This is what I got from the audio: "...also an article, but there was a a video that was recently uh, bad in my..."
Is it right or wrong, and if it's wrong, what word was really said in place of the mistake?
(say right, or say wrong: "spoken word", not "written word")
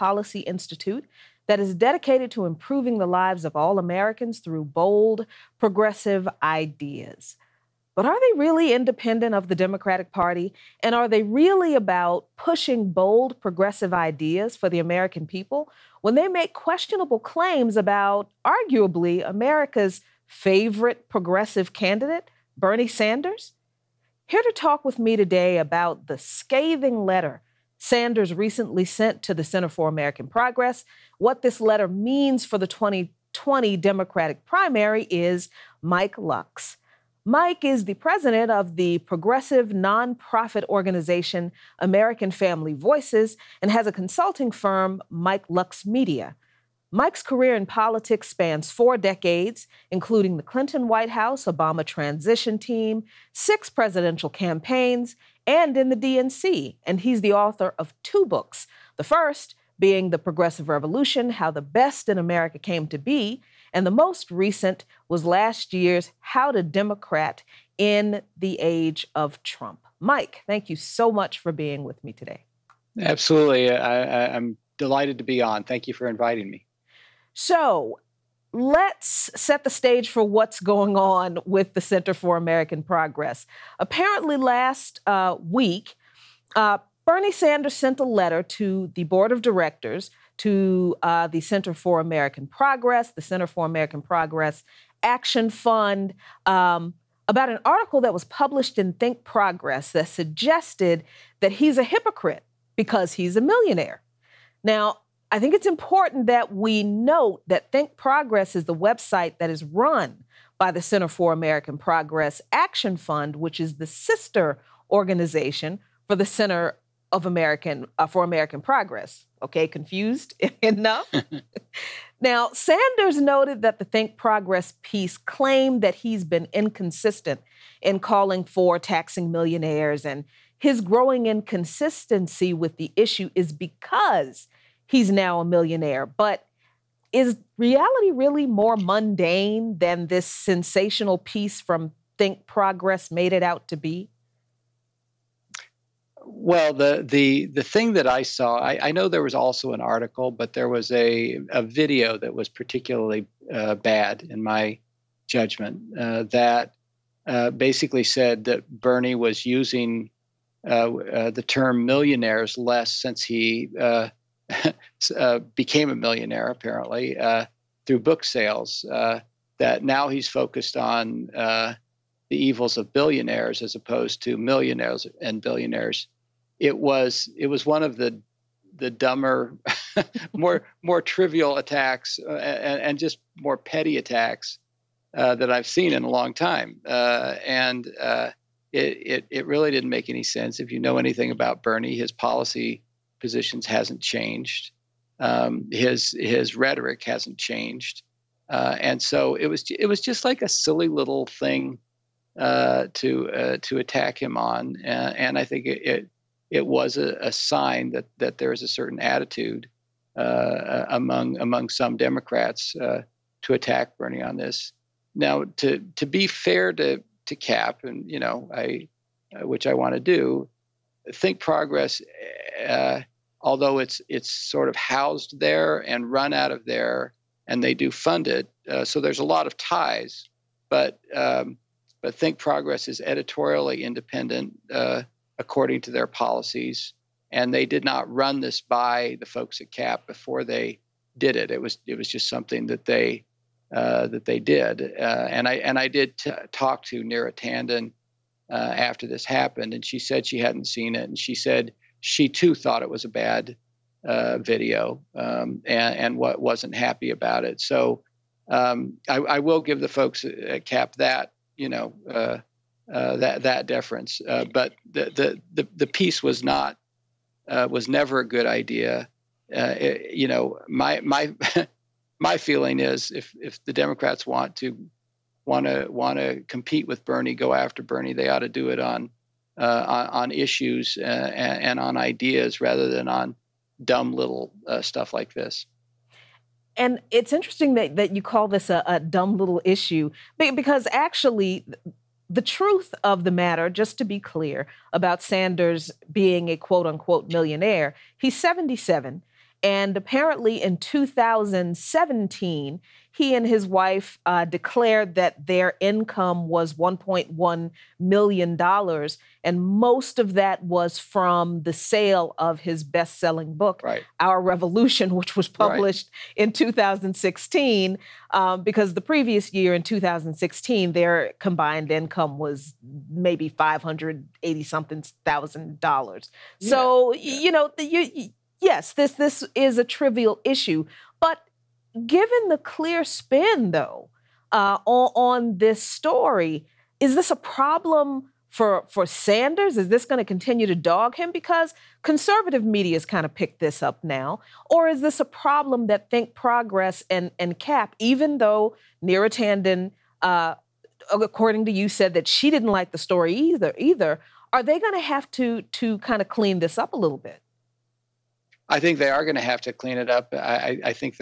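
wrong: "particularly", not "recently".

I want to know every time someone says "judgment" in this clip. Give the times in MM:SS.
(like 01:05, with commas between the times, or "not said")
02:35.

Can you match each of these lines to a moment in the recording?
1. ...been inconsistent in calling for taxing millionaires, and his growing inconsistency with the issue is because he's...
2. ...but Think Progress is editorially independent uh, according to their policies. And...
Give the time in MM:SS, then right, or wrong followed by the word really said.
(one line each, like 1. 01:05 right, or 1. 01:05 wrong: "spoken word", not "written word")
1. 02:06 right
2. 03:52 right.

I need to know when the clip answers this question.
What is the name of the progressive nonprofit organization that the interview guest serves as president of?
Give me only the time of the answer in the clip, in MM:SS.
00:41.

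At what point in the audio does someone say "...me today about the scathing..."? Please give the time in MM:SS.
00:24.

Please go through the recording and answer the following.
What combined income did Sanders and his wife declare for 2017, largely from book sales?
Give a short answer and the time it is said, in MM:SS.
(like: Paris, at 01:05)
$1.1 million, at 05:06.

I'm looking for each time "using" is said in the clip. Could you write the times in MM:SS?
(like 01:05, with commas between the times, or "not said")
02:39.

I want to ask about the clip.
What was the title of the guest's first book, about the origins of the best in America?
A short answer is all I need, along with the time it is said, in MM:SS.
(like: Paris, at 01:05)
The Progressive Revolution, at 01:00.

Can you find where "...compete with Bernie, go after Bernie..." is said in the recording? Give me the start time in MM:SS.
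04:36.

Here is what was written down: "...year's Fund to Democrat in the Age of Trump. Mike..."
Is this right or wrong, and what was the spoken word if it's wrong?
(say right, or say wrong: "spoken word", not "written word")
wrong: "How", not "Fund".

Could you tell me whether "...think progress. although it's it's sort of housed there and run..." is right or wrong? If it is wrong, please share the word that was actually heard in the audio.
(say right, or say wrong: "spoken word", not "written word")
right.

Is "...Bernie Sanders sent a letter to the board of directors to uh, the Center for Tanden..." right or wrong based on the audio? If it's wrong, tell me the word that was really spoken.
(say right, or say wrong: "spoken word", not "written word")
wrong: "American", not "Tanden".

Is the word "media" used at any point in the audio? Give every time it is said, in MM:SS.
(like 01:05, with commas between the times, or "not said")
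00:45, 05:42.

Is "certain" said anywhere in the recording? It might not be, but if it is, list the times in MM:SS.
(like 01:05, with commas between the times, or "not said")
03:28.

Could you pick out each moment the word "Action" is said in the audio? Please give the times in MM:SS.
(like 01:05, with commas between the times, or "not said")
01:35, 01:52.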